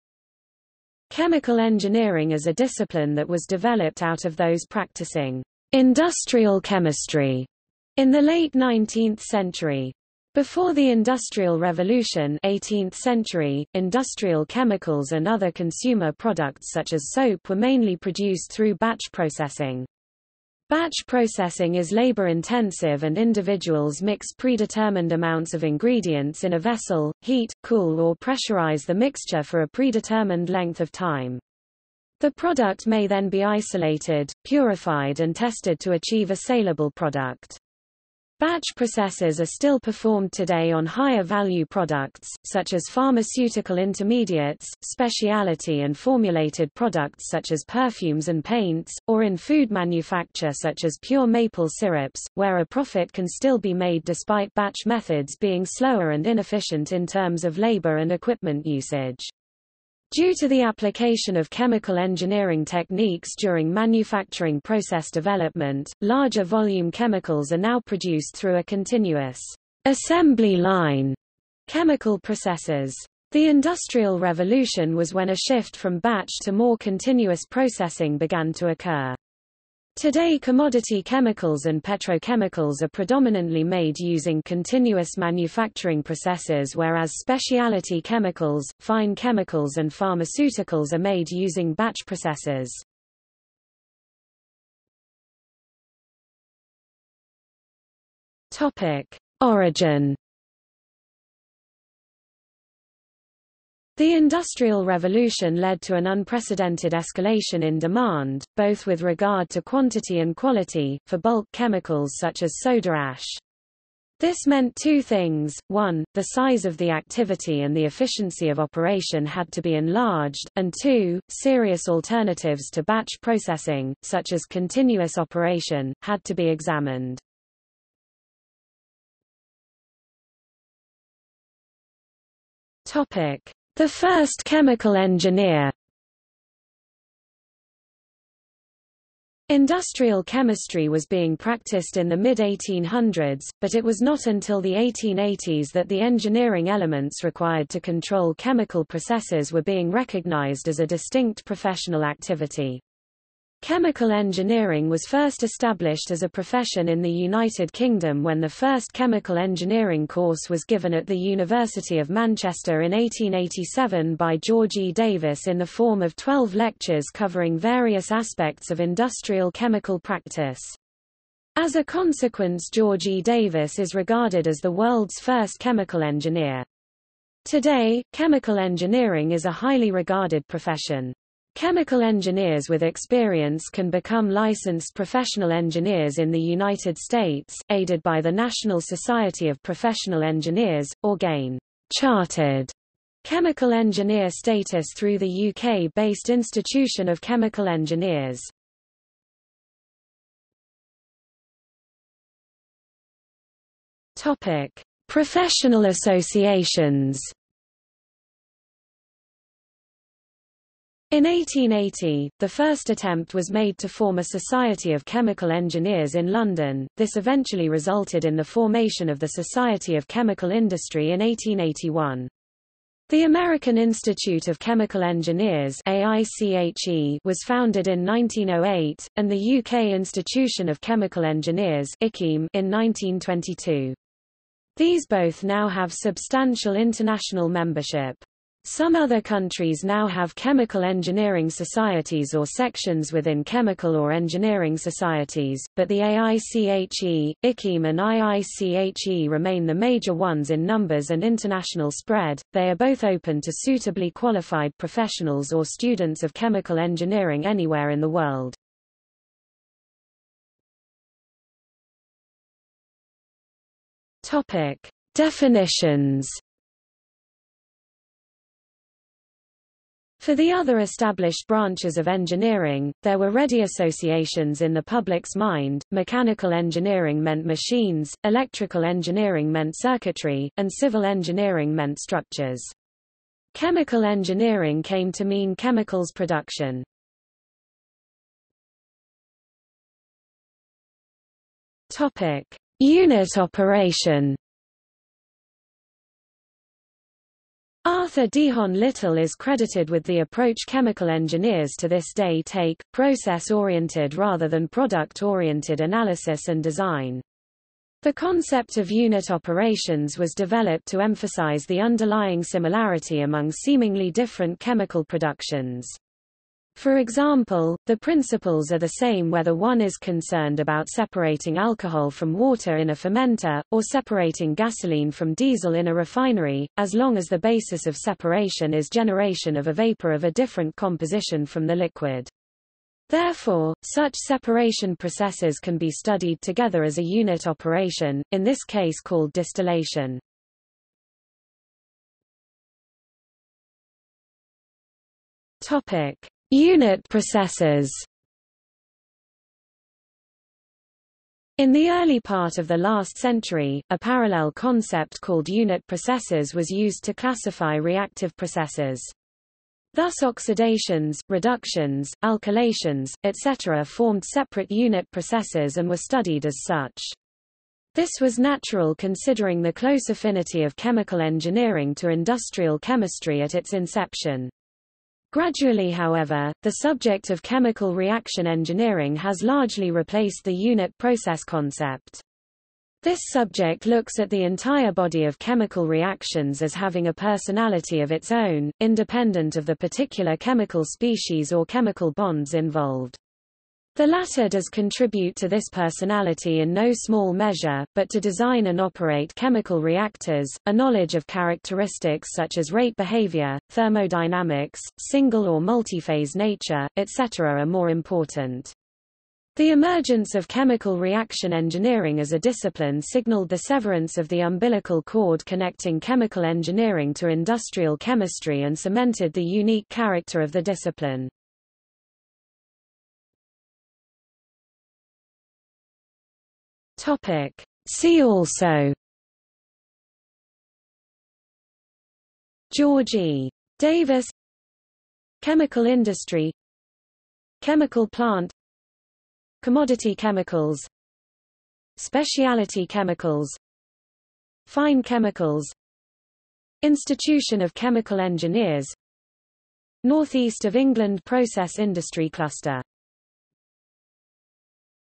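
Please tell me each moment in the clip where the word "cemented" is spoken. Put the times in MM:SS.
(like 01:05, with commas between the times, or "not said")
06:58.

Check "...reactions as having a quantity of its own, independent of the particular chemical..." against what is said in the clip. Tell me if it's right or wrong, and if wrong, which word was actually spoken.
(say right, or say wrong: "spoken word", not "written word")
wrong: "personality", not "quantity".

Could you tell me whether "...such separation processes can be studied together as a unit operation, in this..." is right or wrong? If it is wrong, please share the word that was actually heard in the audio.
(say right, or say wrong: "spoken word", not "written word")
right.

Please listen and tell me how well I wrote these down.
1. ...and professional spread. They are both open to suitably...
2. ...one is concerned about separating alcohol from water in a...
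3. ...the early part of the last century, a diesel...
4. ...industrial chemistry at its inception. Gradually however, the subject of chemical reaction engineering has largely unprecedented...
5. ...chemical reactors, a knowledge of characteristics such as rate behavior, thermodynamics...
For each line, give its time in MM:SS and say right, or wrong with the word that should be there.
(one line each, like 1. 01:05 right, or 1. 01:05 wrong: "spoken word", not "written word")
1. 04:11 wrong: "international", not "professional"
2. 05:19 right
3. 05:51 wrong: "parallel", not "diesel"
4. 06:12 wrong: "replaced", not "unprecedented"
5. 06:39 right.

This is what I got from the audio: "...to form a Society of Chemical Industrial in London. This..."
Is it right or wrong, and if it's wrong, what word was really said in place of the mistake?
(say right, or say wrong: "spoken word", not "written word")
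wrong: "Engineers", not "Industrial".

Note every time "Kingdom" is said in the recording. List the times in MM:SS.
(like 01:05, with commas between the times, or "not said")
02:37.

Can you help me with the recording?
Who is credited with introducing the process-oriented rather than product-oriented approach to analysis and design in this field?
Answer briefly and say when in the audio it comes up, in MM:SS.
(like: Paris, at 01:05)
Arthur Dehon Little, at 04:57.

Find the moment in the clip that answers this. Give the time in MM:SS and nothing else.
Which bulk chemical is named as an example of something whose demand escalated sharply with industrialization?
01:52.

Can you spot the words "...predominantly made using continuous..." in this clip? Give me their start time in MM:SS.
01:22.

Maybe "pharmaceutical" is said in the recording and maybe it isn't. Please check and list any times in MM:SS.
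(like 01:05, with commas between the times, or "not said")
00:42, 01:29.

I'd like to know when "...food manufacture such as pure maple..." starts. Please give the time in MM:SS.
00:49.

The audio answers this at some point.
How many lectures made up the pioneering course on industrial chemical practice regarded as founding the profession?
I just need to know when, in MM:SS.
02:46.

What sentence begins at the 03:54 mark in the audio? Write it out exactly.
These both now have substantial international membership.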